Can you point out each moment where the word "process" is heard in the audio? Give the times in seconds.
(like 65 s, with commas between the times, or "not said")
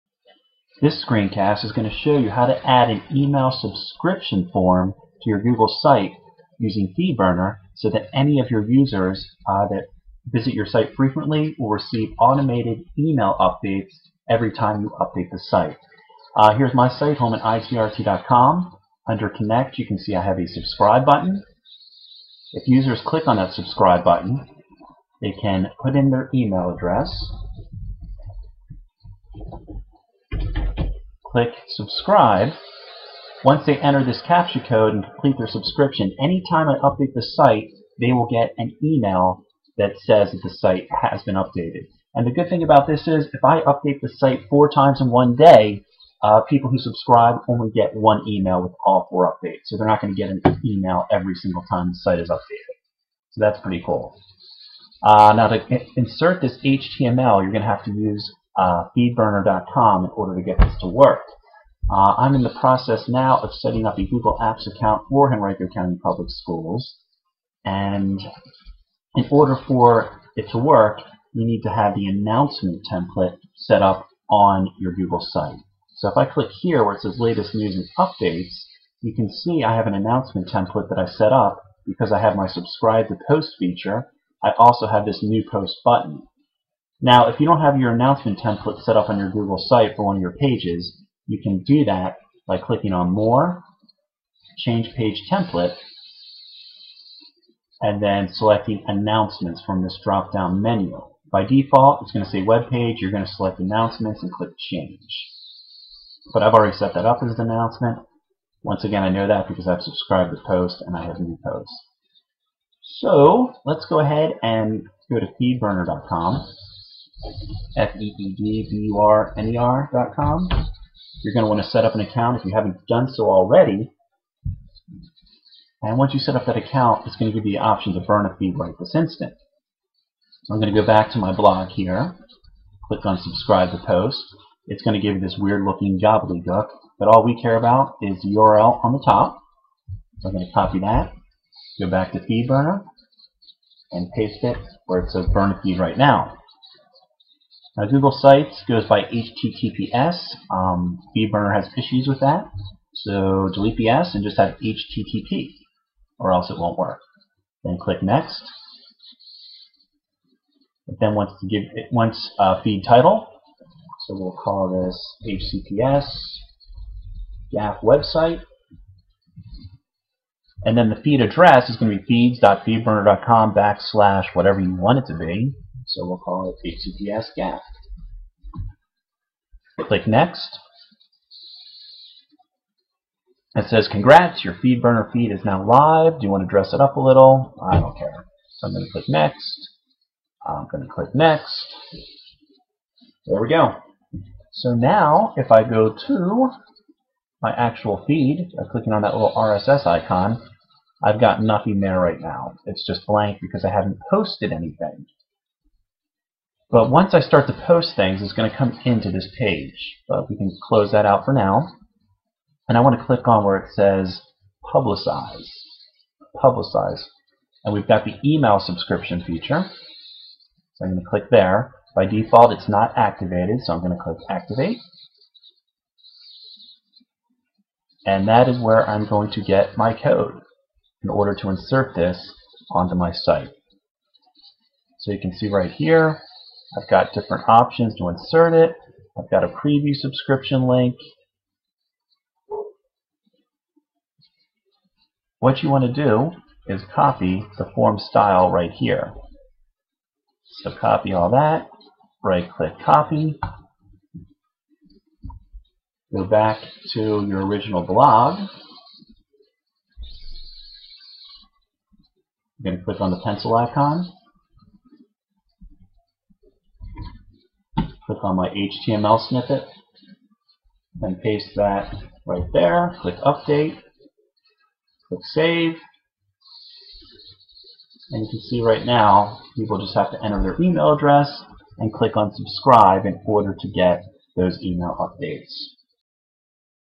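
62 s.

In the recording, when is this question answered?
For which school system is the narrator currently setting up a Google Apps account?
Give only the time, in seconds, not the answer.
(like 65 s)
65 s.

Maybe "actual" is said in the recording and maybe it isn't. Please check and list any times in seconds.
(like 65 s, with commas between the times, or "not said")
197 s.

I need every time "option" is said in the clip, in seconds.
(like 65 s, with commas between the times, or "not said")
127 s, 237 s.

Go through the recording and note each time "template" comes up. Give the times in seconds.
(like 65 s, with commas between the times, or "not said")
72 s, 80 s, 88 s, 95 s.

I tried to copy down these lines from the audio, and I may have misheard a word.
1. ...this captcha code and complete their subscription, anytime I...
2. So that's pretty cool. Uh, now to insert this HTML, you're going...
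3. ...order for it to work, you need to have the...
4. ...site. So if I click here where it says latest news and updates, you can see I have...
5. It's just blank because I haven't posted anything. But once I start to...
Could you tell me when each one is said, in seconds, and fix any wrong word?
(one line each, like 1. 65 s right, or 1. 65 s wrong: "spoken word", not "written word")
1. 34 s right
2. 53 s right
3. 69 s right
4. 75 s right
5. 202 s right.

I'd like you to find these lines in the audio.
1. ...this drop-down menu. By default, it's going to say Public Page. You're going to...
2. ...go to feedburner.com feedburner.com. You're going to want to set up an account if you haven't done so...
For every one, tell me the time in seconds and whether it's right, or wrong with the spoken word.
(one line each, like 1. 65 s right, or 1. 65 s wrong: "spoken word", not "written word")
1. 99 s wrong: "Web", not "Public"
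2. 115 s right.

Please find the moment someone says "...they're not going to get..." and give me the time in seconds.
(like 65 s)
49 s.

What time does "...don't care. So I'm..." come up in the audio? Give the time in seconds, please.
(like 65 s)
187 s.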